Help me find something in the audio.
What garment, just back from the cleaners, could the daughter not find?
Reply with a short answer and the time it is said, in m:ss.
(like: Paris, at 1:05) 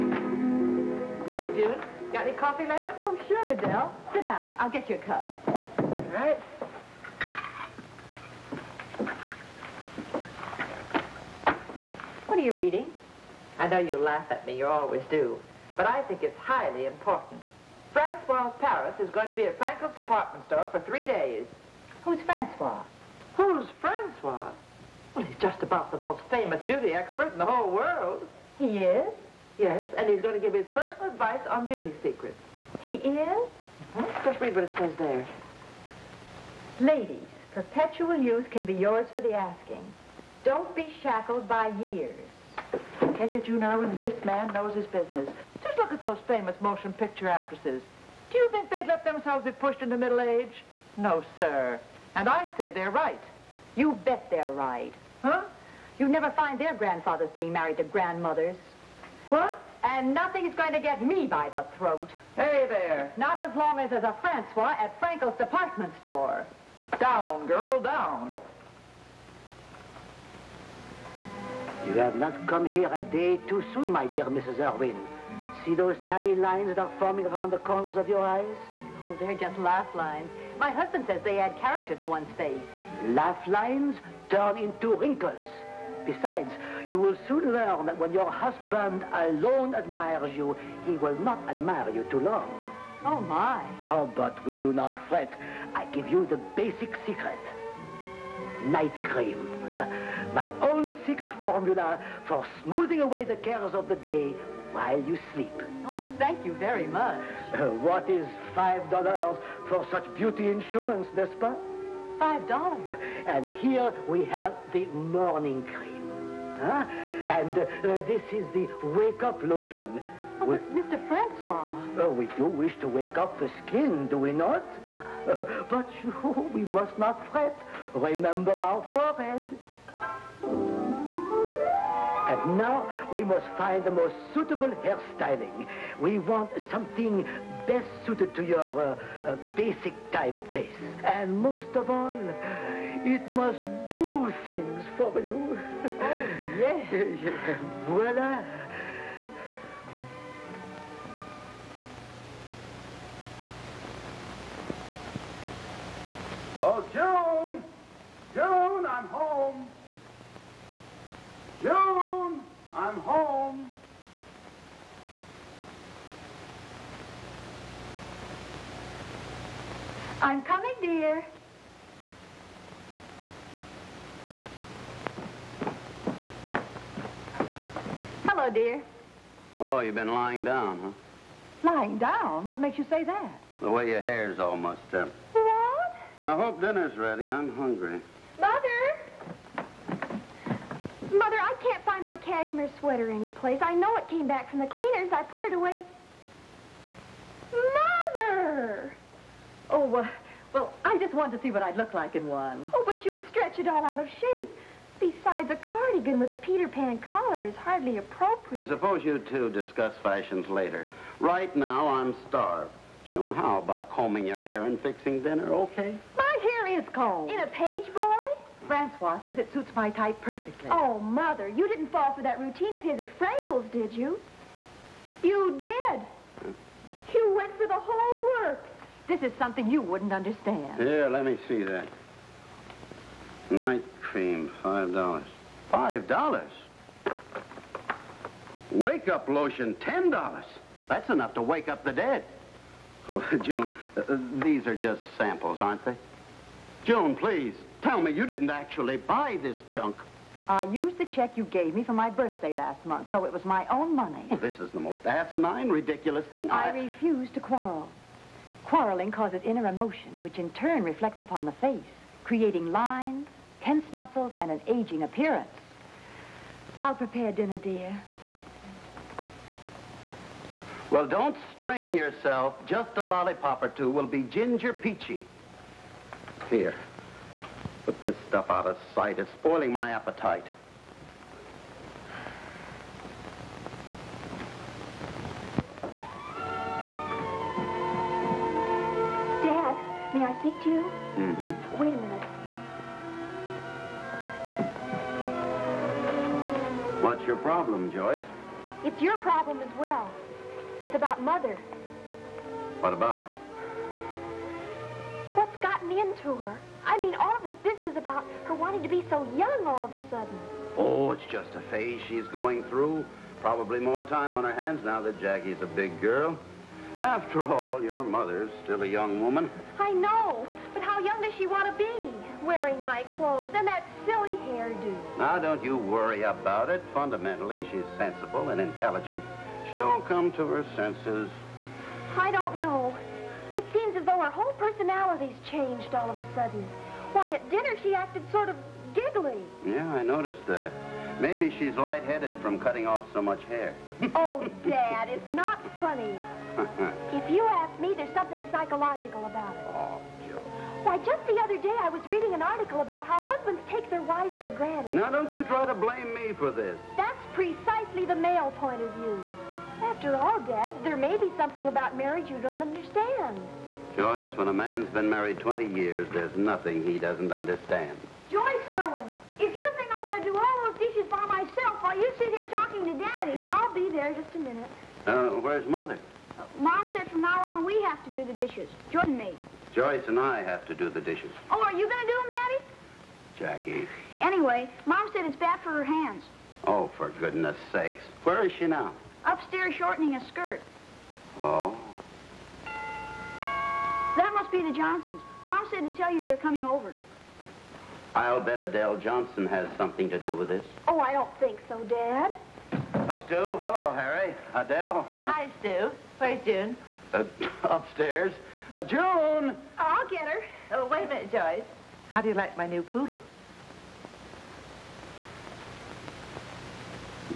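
Cashmere sweater, at 3:12.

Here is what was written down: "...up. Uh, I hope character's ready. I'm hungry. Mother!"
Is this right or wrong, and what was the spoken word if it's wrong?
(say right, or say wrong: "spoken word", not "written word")
wrong: "dinner", not "character".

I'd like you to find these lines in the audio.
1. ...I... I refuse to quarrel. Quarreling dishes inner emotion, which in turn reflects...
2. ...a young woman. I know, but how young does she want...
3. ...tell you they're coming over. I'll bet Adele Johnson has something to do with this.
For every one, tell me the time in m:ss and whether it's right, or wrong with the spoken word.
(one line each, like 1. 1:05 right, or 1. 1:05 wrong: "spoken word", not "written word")
1. 4:16 wrong: "causes", not "dishes"
2. 5:18 right
3. 6:35 right.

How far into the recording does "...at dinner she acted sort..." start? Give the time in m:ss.
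5:37.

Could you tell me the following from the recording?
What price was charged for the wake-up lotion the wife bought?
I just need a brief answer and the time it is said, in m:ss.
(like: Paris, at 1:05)
$10, at 3:59.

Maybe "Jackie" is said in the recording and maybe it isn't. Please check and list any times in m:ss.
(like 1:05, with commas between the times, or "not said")
5:15, 6:23.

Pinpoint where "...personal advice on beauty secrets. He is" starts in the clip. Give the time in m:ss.
0:30.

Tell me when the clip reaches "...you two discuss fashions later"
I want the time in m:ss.
3:29.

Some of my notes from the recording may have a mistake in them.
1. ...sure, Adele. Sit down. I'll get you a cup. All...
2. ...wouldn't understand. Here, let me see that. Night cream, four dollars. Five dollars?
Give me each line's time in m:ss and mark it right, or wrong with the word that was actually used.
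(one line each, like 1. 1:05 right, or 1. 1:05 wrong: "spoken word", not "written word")
1. 0:03 right
2. 3:49 wrong: "five", not "four".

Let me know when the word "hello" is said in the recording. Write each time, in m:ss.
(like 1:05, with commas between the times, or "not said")
2:58, 6:43.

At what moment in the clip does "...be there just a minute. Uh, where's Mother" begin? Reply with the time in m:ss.
6:13.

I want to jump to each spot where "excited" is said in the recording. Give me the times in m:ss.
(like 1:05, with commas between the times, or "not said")
not said.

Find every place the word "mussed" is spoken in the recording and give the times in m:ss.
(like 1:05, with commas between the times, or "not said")
3:04.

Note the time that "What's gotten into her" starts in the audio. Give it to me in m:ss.
5:05.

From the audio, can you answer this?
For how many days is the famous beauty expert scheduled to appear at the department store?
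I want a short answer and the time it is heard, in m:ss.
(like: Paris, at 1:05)
3, at 0:20.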